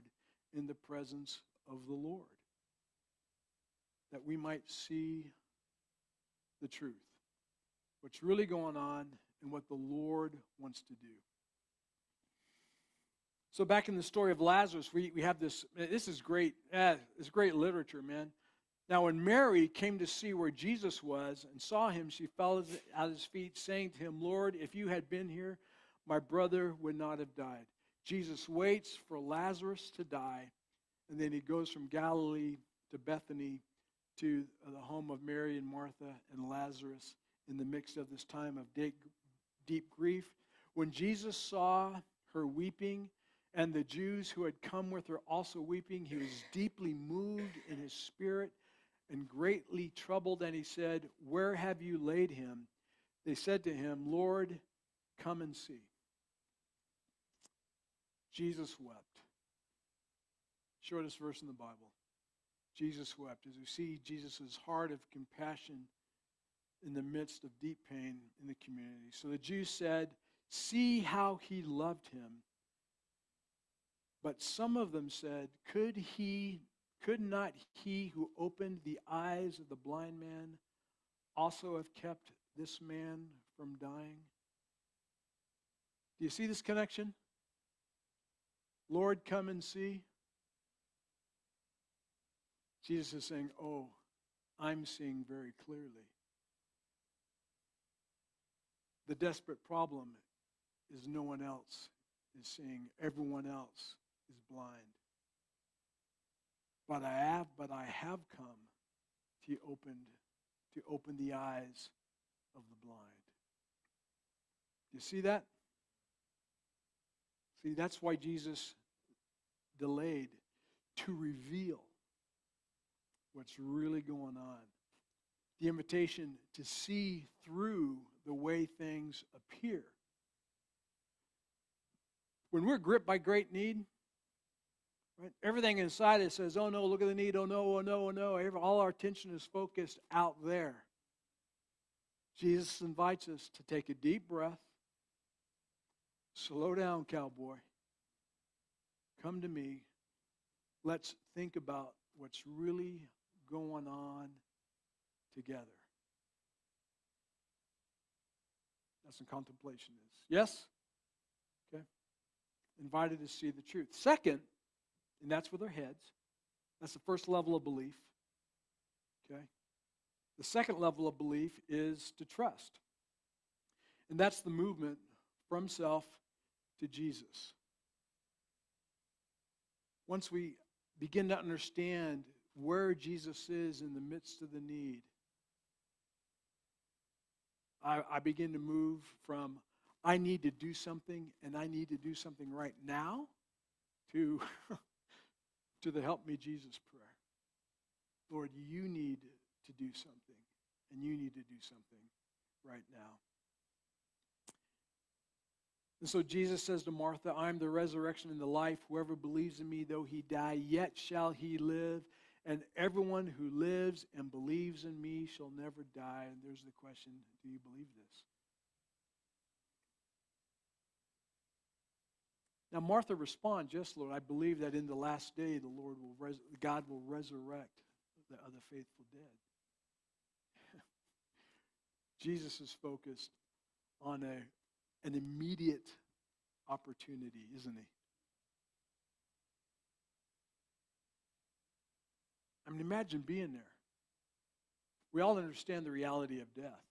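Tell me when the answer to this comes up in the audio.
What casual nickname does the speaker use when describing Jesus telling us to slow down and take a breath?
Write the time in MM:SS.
02:27.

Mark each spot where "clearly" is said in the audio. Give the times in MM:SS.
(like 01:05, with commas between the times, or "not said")
01:35.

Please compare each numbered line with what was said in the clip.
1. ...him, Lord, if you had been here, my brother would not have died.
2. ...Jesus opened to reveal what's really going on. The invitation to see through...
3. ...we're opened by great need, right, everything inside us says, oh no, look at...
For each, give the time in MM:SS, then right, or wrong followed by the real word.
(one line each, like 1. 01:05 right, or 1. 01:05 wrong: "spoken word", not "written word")
1. 00:23 right
2. 01:58 wrong: "delayed", not "opened"
3. 02:12 wrong: "gripped", not "opened".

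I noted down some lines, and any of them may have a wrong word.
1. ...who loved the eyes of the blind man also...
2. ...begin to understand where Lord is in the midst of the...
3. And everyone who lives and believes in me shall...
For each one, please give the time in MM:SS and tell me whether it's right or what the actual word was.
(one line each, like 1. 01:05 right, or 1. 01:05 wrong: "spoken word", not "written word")
1. 01:18 wrong: "opened", not "loved"
2. 03:00 wrong: "Jesus", not "Lord"
3. 03:32 right.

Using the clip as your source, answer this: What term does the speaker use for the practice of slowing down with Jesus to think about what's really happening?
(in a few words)
contemplation.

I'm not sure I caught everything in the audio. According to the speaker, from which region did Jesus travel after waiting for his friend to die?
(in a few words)
Galilee.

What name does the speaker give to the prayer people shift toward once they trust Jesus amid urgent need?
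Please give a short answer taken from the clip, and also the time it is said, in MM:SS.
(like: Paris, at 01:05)
Help Me Jesus prayer, at 03:16.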